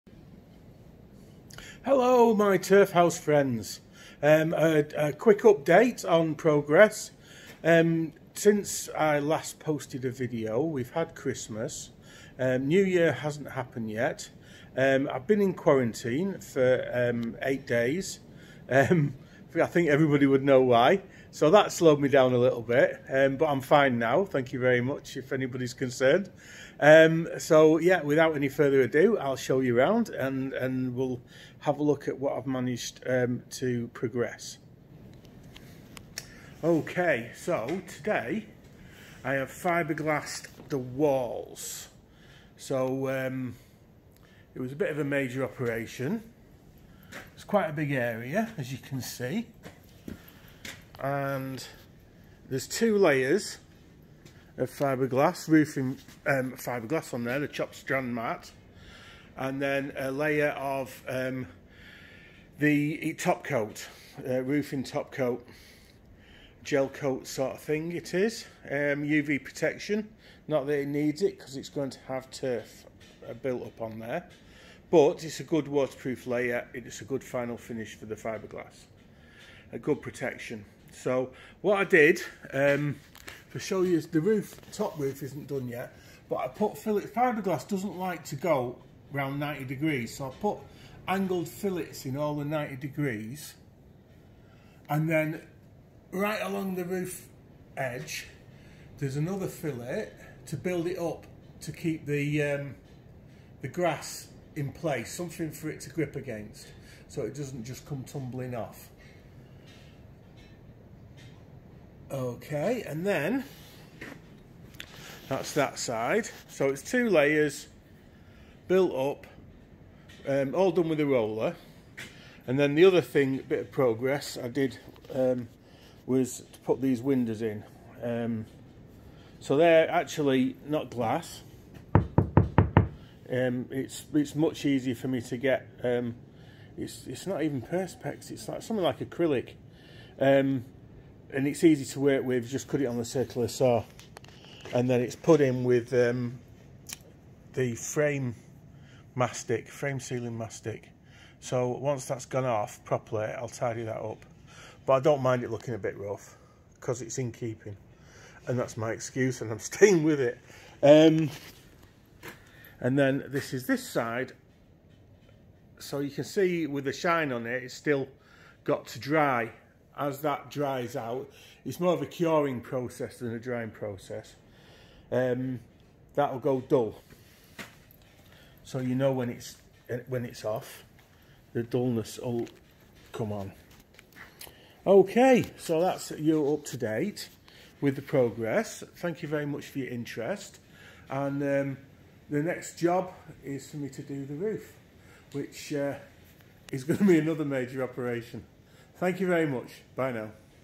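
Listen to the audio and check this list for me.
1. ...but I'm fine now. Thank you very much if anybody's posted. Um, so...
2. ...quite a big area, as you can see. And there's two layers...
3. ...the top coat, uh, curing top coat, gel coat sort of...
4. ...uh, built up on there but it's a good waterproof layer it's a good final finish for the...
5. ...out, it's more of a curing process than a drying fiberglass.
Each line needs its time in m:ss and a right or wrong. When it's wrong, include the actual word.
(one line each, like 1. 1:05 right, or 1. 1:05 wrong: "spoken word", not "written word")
1. 0:23 wrong: "concerned", not "posted"
2. 0:47 right
3. 1:02 wrong: "roofing", not "curing"
4. 1:13 right
5. 2:50 wrong: "process", not "fiberglass".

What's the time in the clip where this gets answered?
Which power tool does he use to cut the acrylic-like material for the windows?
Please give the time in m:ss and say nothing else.
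2:23.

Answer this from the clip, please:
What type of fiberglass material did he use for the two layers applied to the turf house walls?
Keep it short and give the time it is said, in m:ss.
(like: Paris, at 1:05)
chopped strand mat, at 0:57.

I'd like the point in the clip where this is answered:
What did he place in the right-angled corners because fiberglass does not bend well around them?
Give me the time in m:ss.
1:31.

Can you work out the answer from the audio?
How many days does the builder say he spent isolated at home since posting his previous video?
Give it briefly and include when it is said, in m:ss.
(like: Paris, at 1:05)
8, at 0:17.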